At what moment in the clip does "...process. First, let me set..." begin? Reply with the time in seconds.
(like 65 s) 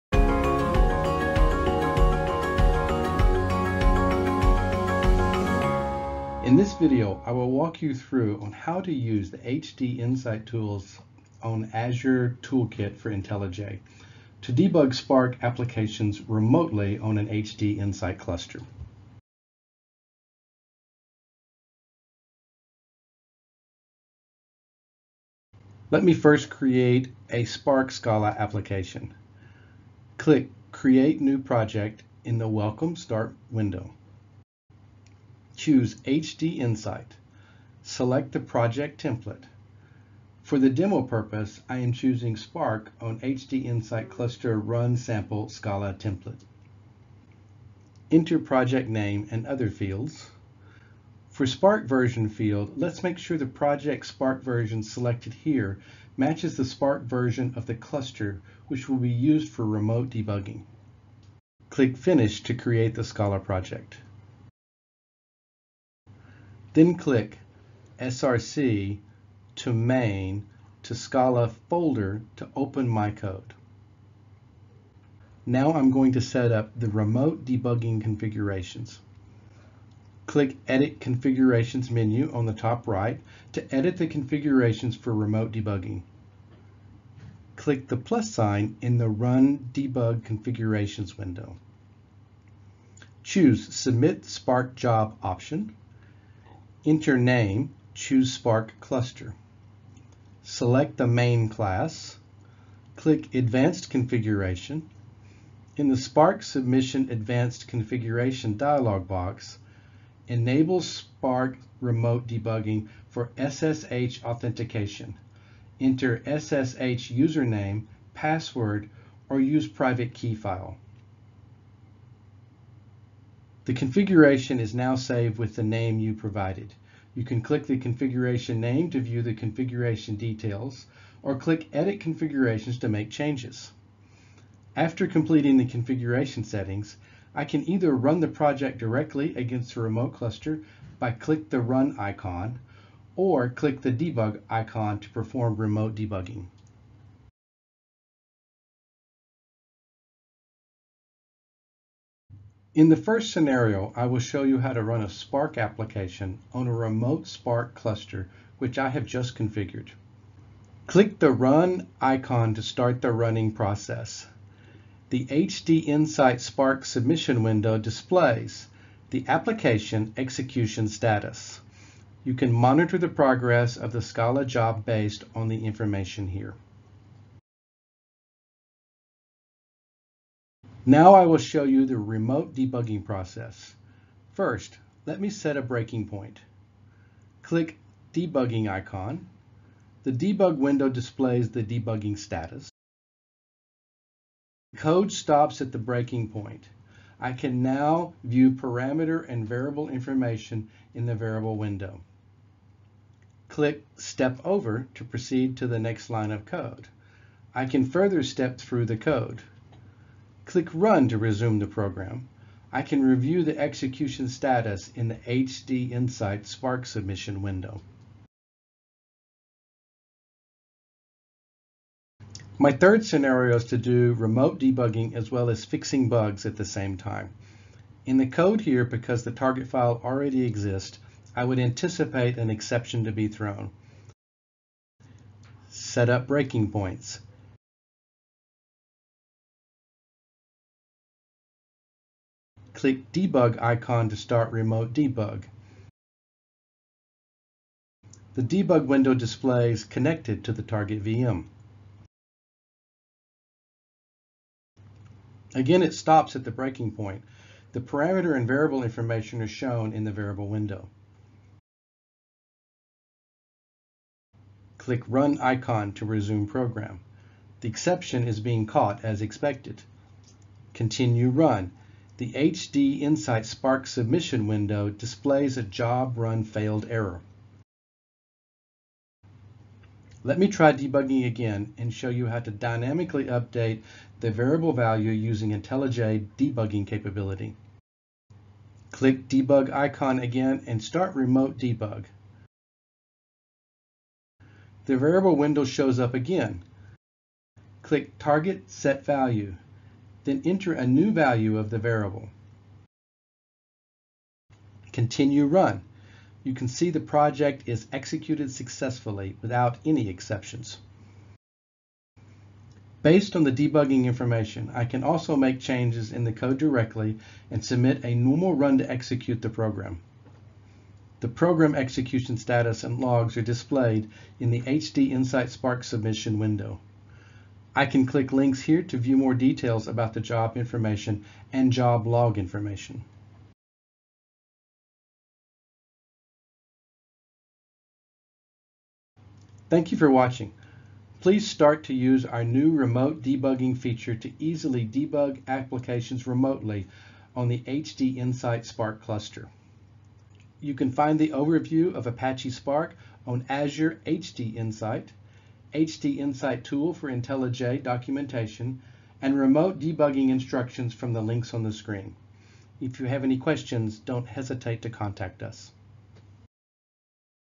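183 s.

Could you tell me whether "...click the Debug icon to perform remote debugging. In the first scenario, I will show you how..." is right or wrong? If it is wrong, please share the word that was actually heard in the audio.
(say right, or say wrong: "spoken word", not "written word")
right.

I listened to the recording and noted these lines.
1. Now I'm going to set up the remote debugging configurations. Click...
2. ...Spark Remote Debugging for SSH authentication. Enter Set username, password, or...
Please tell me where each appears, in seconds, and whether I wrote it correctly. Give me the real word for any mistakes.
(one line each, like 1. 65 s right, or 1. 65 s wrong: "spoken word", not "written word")
1. 75 s right
2. 110 s wrong: "SSH", not "Set".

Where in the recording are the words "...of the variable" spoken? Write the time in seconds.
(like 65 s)
301 s.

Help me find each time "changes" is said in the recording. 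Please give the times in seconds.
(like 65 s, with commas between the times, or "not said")
133 s, 315 s.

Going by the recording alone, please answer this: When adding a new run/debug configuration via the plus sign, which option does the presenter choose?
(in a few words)
Submit Spark Job.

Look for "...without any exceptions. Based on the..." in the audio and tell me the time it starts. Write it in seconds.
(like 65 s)
309 s.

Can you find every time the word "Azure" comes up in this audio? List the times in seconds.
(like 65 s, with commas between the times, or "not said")
11 s, 353 s.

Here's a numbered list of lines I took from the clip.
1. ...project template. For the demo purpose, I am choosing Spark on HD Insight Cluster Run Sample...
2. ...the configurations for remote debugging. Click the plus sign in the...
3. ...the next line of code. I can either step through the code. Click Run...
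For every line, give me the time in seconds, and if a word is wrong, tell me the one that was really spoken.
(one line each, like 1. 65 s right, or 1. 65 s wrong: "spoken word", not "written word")
1. 38 s right
2. 83 s right
3. 205 s wrong: "further", not "either".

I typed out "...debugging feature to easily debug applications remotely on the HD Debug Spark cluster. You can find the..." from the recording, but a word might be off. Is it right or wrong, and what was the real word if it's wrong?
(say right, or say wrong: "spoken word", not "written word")
wrong: "Insight", not "Debug".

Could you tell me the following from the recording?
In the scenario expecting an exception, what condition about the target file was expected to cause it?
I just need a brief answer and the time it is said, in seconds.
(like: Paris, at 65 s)
already exists, at 230 s.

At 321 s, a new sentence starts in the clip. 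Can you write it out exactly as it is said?
The program execution status and logs are displayed in the HD Insight Spark submission window.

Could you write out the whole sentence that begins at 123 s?
The configuration is now saved with the name you provided.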